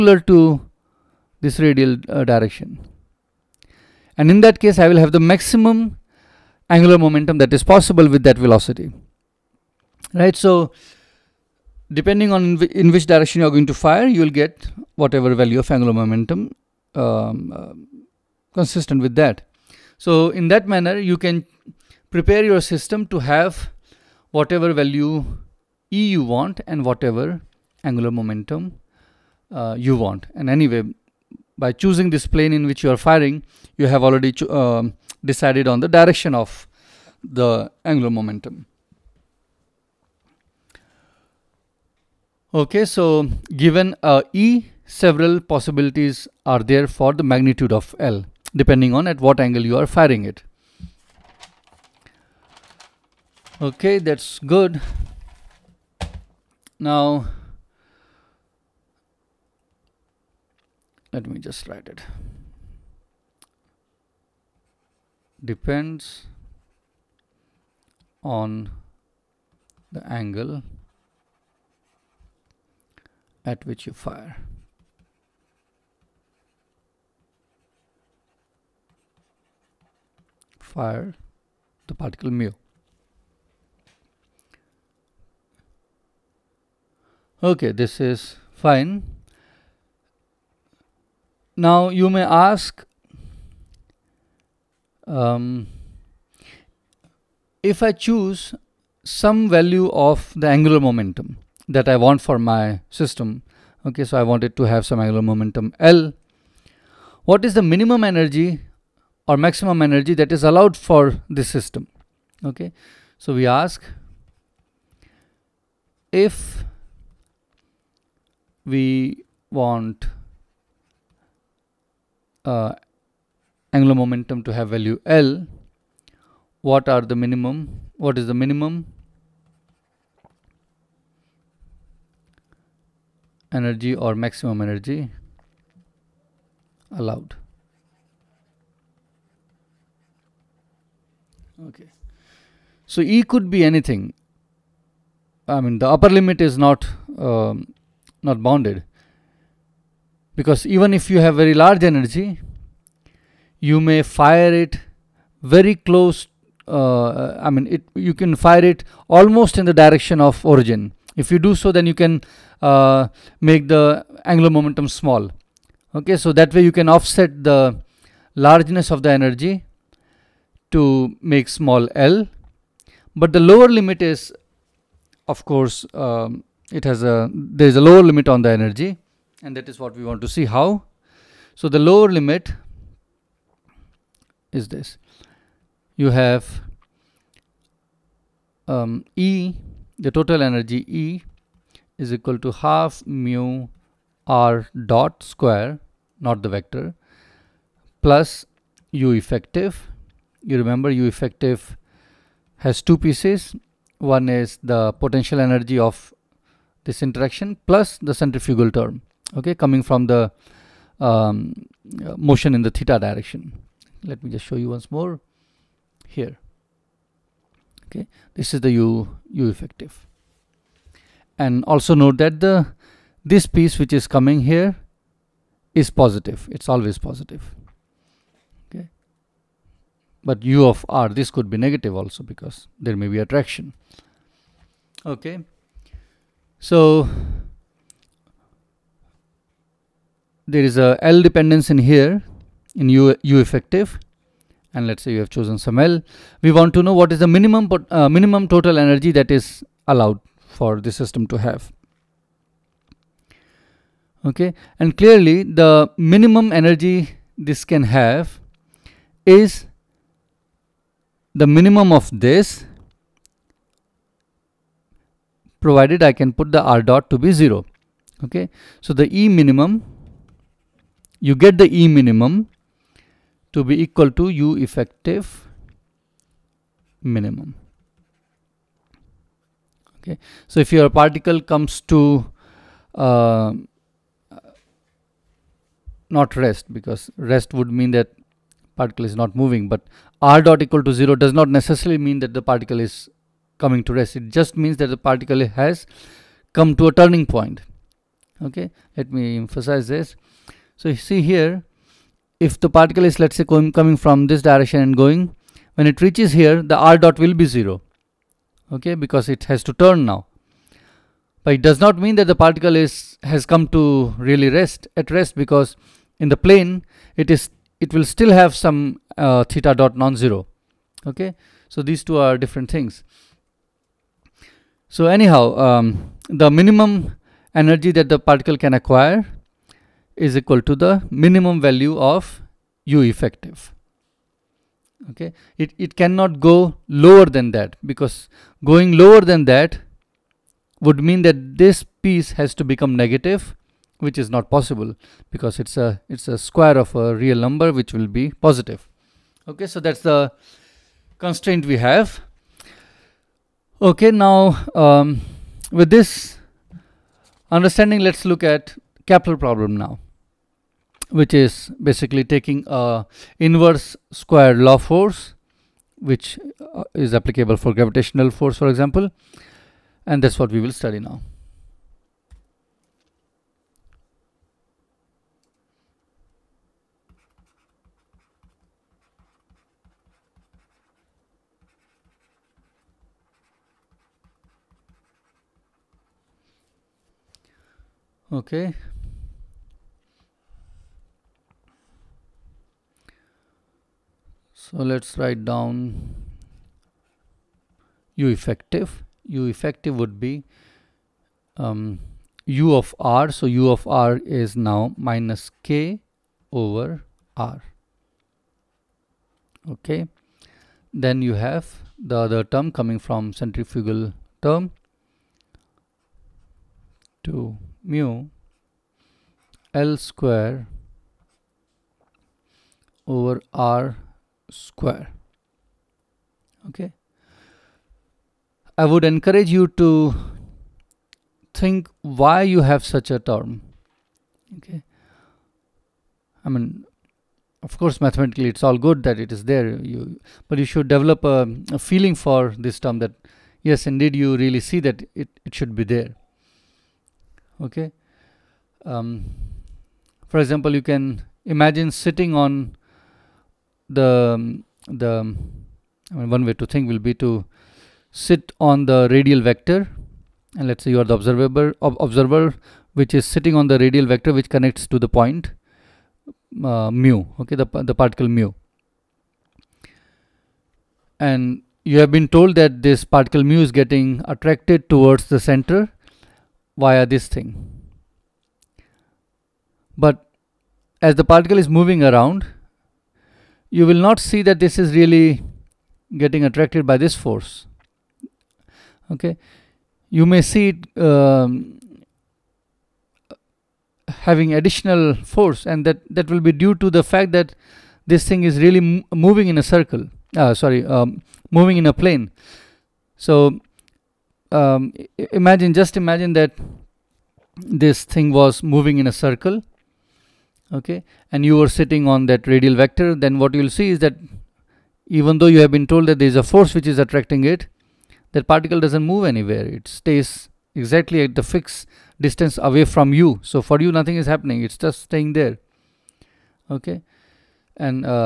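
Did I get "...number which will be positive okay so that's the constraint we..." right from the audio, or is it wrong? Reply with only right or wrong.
right.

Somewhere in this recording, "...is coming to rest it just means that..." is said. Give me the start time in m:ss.
4:52.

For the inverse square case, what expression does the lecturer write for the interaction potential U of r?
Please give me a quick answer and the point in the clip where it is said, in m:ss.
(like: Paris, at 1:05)
Minus k over r, at 6:44.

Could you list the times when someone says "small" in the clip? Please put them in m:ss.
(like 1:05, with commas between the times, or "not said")
2:44, 2:51.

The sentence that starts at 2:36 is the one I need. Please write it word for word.
Uh, I mean, it you can fire it almost in the direction of origin.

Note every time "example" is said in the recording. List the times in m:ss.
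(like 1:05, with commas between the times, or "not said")
6:08, 7:30.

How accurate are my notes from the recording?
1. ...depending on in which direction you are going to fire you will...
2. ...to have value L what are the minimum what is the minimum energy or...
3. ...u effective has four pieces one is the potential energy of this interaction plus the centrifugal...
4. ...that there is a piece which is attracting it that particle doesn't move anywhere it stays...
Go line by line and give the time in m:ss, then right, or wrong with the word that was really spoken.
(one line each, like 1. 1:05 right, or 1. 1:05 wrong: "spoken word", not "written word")
1. 0:11 right
2. 2:04 right
3. 3:20 wrong: "two", not "four"
4. 8:36 wrong: "force", not "piece".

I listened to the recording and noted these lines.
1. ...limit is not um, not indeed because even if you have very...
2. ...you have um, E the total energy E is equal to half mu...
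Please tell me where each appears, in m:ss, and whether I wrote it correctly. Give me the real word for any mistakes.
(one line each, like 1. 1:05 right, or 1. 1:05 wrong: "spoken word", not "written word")
1. 2:26 wrong: "bounded", not "indeed"
2. 3:05 right.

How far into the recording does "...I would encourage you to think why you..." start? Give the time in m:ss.
7:08.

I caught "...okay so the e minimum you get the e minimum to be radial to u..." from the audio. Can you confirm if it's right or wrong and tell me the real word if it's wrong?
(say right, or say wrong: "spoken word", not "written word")
wrong: "equal", not "radial".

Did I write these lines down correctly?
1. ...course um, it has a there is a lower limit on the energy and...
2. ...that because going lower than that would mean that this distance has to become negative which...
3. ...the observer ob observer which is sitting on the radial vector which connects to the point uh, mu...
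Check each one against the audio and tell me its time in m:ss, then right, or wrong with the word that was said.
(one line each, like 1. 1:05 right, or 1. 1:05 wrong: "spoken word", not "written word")
1. 2:55 right
2. 5:37 wrong: "piece", not "distance"
3. 7:41 right.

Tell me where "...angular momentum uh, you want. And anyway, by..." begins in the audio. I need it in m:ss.
0:27.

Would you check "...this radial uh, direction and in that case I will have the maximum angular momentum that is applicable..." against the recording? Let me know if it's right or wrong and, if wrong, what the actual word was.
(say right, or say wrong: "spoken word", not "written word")
wrong: "possible", not "applicable".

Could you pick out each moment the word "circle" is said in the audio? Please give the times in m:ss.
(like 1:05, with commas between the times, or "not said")
8:19, 8:29.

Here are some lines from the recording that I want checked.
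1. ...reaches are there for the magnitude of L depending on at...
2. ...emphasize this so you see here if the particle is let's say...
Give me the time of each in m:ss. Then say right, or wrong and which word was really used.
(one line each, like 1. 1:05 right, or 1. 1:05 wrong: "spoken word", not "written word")
1. 0:45 wrong: "possibilities", not "reaches"
2. 4:59 right.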